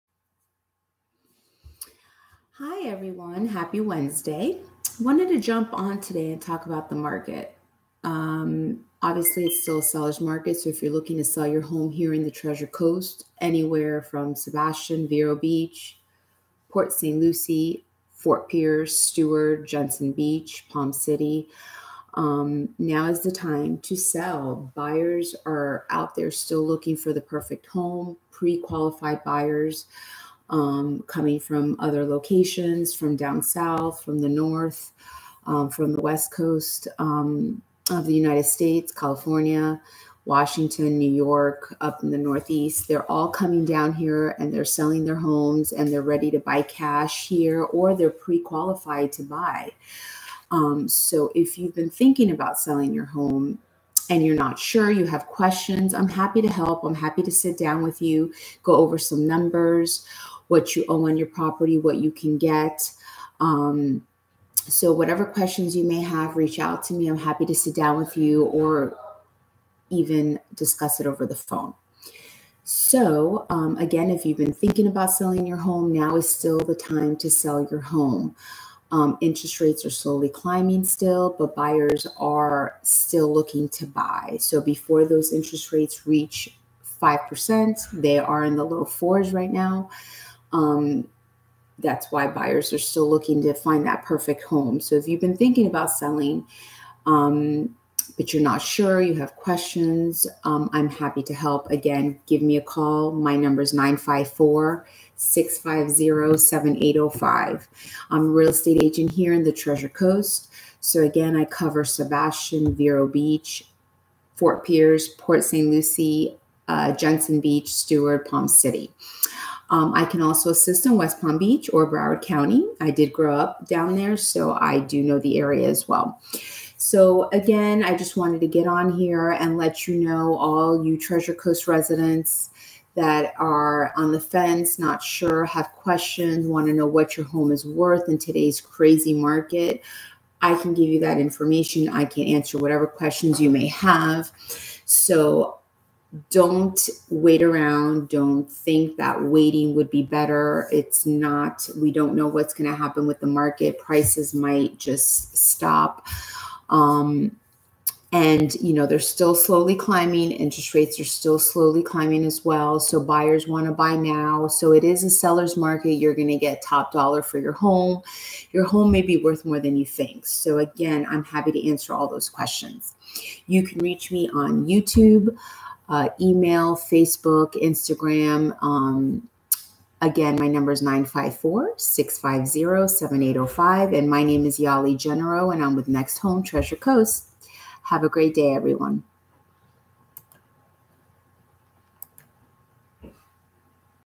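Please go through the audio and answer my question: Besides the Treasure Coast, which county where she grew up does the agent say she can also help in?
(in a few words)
Broward County.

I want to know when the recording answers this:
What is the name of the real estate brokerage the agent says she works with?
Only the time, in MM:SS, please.
03:05.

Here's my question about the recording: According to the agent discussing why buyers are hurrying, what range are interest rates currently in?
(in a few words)
low fours.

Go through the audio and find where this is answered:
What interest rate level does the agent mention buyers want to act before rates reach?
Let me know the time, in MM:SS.
01:27.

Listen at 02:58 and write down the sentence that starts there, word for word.
Um, again, my number is 954 650 7805.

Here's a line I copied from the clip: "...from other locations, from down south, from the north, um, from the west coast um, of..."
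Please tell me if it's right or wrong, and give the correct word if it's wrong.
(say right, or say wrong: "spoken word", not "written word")
right.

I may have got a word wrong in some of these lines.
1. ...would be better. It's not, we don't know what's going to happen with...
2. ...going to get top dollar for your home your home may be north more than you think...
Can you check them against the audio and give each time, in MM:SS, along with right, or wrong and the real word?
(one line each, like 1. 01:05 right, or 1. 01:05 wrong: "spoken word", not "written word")
1. 02:29 right
2. 02:46 wrong: "worth", not "north".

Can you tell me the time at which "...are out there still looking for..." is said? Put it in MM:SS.
00:25.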